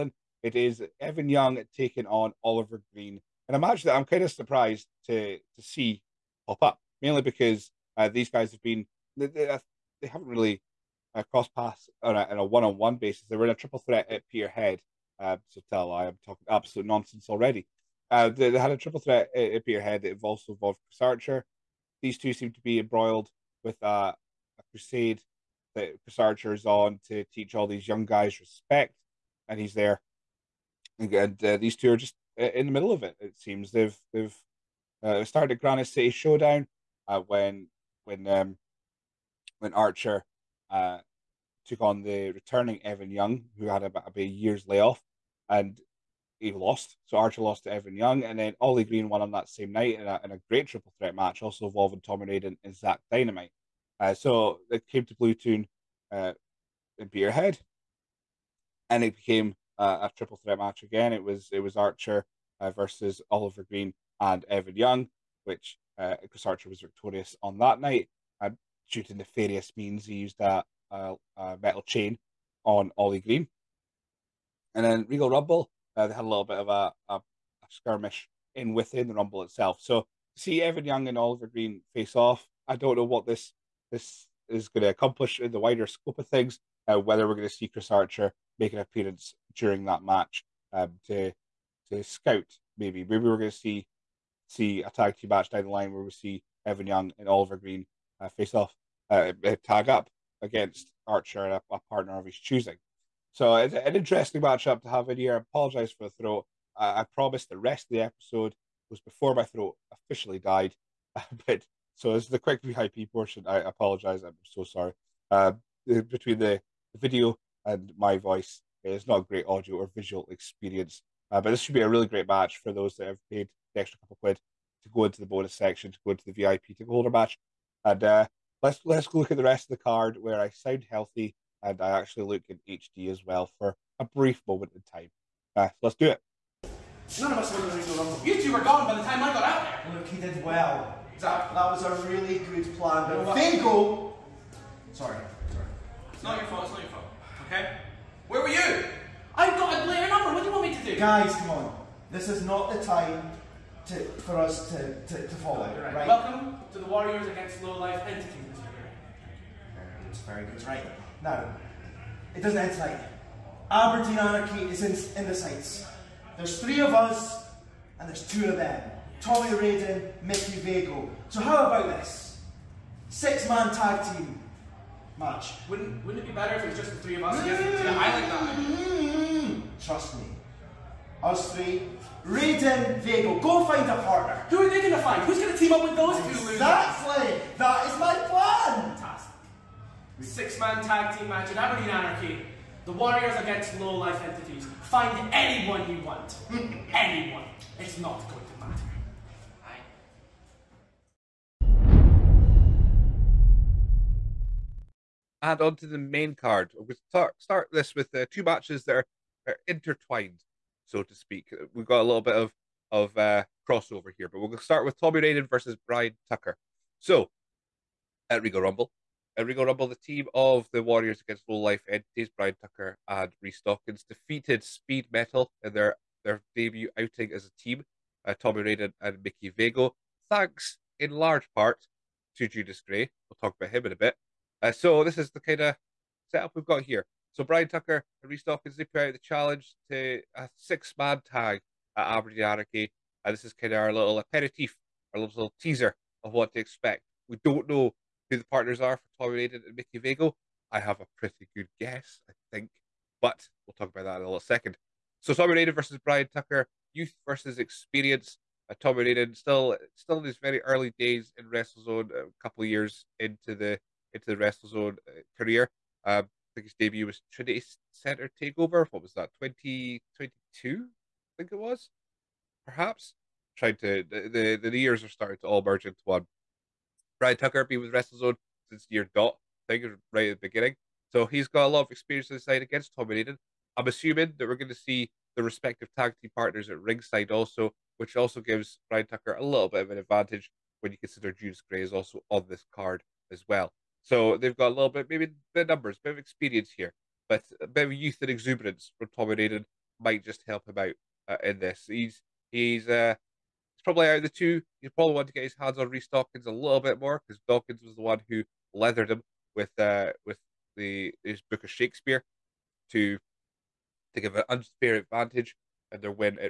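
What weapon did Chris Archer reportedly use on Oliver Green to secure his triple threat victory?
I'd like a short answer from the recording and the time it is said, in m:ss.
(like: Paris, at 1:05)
metal chain, at 1:11.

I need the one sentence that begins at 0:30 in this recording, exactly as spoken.
And uh, these two are just uh, in the middle of it.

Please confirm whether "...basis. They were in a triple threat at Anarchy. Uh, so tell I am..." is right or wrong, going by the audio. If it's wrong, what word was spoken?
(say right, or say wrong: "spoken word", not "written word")
wrong: "Peterhead", not "Anarchy".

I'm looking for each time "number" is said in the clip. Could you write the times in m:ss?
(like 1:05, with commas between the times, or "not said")
2:30, 4:55.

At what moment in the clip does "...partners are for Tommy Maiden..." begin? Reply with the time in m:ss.
4:08.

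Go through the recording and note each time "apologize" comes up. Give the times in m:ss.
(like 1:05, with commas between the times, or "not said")
1:45, 1:53.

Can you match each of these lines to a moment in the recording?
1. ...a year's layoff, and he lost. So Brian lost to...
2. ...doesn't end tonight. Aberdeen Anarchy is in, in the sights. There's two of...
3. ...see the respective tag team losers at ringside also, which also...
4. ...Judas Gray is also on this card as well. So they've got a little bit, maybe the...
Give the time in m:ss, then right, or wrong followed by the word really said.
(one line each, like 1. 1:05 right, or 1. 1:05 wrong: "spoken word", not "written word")
1. 0:44 wrong: "Archer", not "Brian"
2. 2:42 wrong: "three", not "two"
3. 4:44 wrong: "partners", not "losers"
4. 4:51 right.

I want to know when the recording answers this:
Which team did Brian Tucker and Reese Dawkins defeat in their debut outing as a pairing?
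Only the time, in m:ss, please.
3:44.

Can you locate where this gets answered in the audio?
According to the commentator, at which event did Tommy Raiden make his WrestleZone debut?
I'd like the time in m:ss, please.
4:27.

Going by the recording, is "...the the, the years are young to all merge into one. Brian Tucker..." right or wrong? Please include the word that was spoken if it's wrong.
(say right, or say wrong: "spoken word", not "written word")
wrong: "starting", not "young".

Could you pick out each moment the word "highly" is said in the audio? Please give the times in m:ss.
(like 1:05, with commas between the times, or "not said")
not said.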